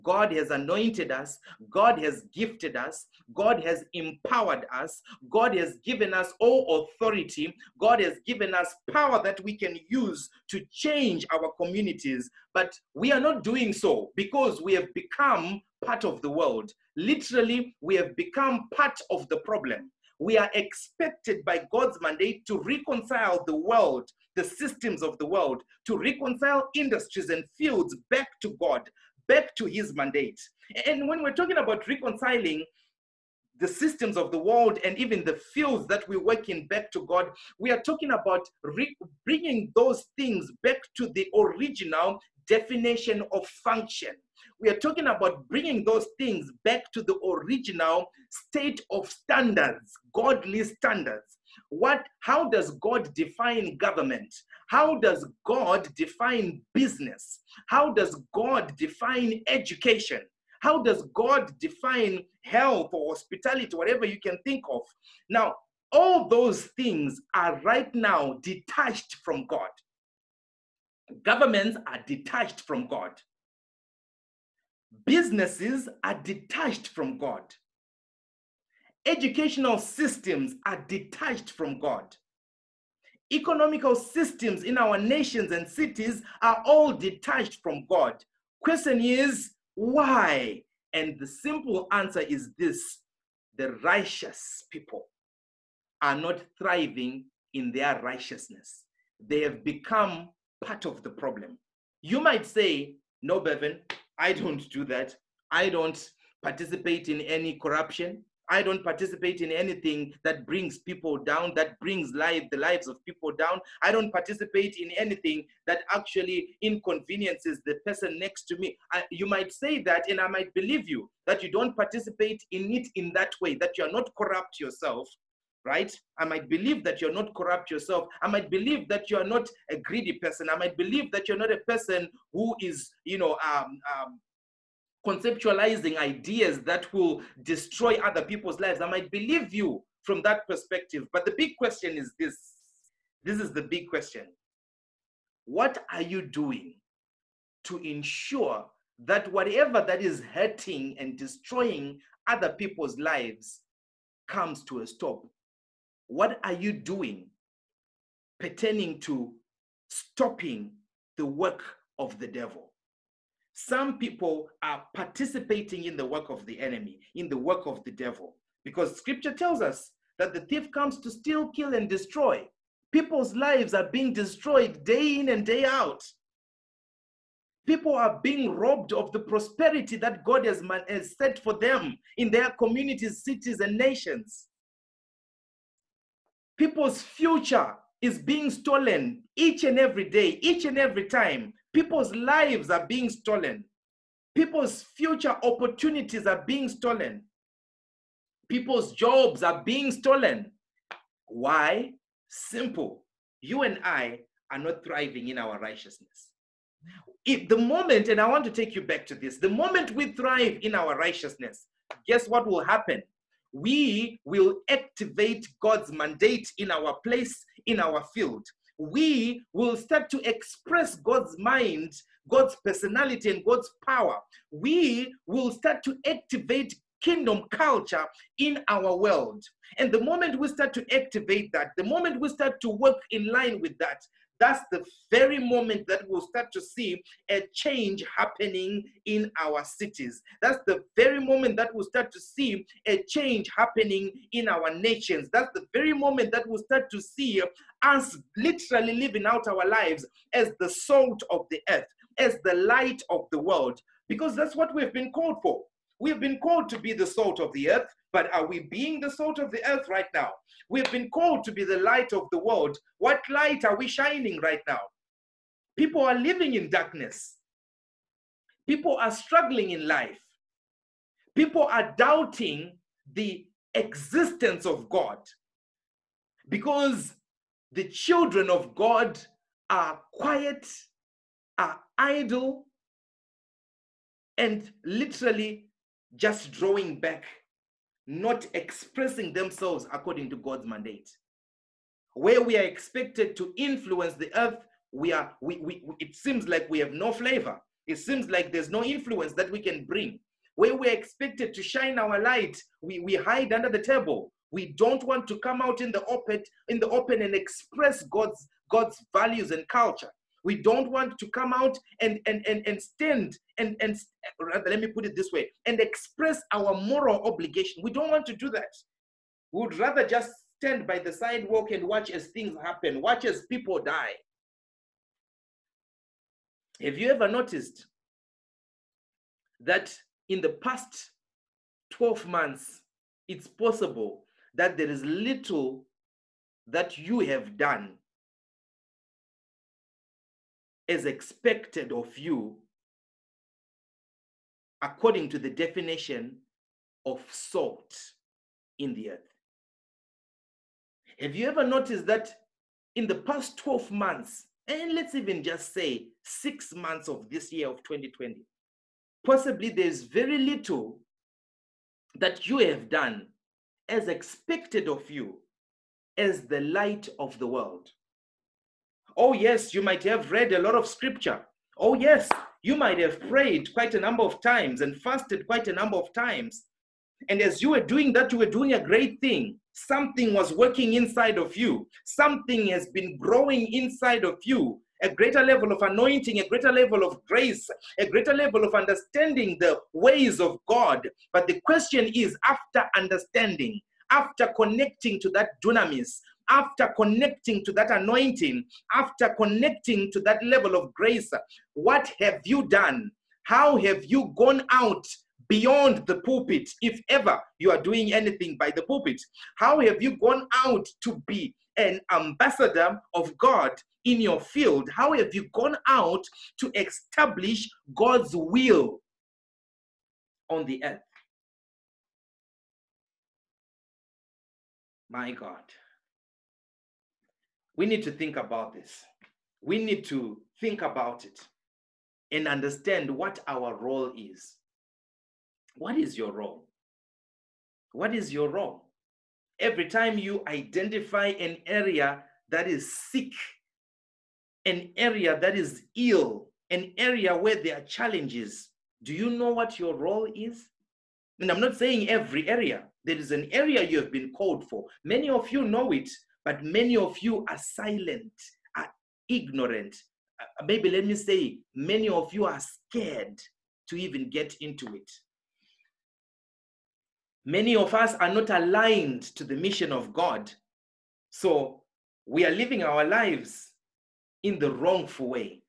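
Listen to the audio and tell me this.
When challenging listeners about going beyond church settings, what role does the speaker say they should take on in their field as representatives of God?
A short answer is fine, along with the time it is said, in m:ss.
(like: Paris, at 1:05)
Ambassador of God, at 6:52.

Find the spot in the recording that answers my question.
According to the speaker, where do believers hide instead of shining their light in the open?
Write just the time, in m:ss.
5:03.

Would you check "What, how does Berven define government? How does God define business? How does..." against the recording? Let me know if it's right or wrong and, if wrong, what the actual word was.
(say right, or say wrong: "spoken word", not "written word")
wrong: "God", not "Berven".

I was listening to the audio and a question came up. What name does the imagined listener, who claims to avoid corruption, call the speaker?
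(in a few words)
Berven.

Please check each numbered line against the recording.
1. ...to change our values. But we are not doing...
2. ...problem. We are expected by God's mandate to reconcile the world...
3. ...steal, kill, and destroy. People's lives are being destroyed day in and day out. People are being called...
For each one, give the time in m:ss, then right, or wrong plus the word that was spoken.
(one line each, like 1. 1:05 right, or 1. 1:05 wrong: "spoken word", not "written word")
1. 0:10 wrong: "communities", not "values"
2. 0:19 right
3. 2:51 wrong: "robbed", not "called".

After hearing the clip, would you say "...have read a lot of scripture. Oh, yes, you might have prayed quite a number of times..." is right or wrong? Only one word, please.
right.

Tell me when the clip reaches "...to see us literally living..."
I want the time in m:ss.
4:06.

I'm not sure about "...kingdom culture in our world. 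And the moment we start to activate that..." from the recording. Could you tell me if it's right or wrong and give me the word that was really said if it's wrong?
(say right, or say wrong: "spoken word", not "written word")
right.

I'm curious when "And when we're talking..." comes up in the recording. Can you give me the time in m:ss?
0:30.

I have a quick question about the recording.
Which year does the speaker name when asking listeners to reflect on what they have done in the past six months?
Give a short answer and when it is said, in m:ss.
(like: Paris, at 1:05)
2020, at 5:57.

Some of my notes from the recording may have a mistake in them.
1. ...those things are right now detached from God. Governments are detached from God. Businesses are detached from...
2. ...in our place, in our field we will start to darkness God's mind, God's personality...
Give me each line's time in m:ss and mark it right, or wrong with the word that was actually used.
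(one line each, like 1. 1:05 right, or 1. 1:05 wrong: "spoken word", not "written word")
1. 1:06 right
2. 3:36 wrong: "express", not "darkness".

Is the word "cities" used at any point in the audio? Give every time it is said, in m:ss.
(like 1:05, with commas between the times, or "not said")
1:25, 3:03, 3:59.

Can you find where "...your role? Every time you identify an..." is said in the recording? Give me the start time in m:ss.
7:18.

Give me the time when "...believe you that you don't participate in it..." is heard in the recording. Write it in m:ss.
2:00.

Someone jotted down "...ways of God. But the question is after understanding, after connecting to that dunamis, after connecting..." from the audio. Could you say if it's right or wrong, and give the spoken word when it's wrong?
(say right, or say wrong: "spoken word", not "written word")
right.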